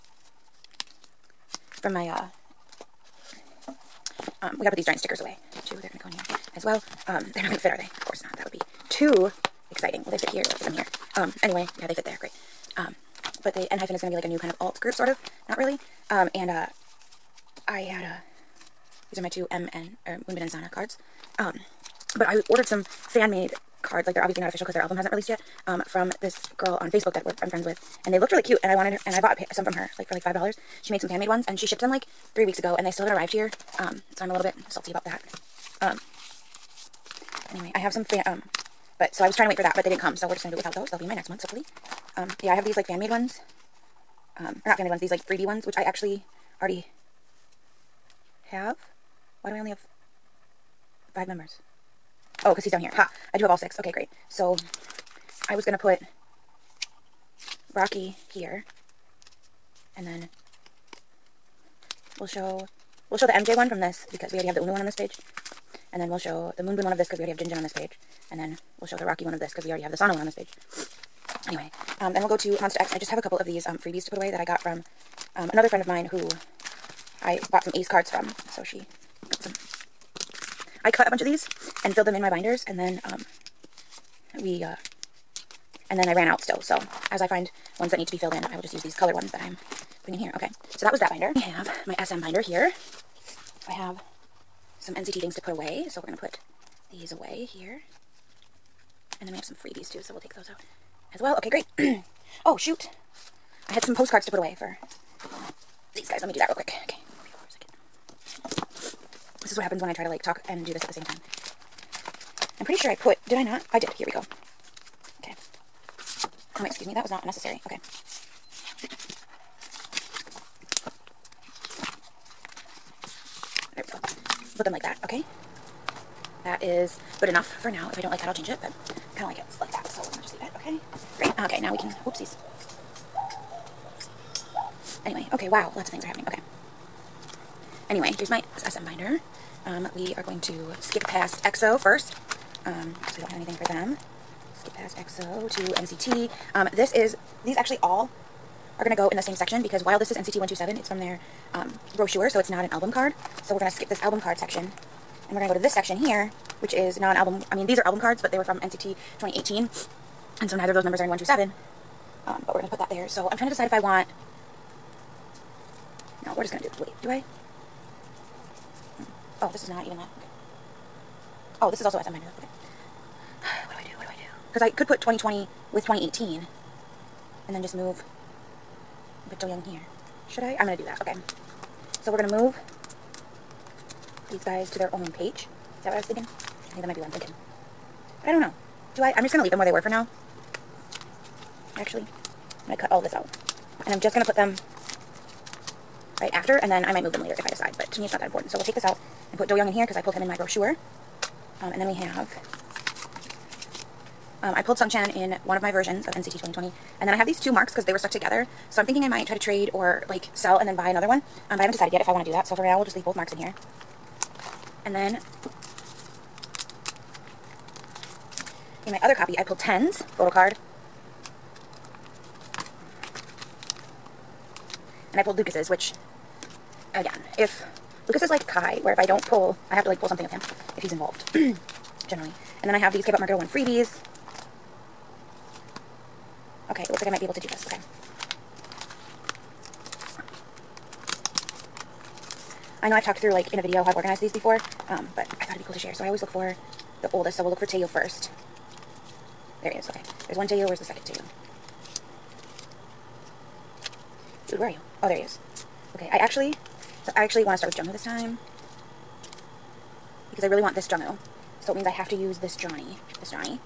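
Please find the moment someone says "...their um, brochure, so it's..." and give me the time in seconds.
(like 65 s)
150 s.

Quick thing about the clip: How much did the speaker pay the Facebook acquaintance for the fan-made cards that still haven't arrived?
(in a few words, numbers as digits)
$5.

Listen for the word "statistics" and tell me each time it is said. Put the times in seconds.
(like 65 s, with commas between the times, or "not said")
not said.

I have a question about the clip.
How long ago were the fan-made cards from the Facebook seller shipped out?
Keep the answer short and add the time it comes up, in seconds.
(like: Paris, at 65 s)
three weeks, at 32 s.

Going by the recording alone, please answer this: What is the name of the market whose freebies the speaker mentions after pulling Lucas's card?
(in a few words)
K-Pop Market 01.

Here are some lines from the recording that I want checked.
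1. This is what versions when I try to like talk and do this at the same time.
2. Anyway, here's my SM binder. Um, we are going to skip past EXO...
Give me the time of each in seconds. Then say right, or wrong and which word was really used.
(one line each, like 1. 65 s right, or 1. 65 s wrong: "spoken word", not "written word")
1. 109 s wrong: "happens", not "versions"
2. 137 s right.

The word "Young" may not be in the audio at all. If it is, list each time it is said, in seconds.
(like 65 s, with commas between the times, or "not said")
179 s, 199 s.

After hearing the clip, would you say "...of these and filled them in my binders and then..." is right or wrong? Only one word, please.
right.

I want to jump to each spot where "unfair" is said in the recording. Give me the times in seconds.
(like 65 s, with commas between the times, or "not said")
not said.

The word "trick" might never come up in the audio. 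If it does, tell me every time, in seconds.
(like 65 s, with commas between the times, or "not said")
not said.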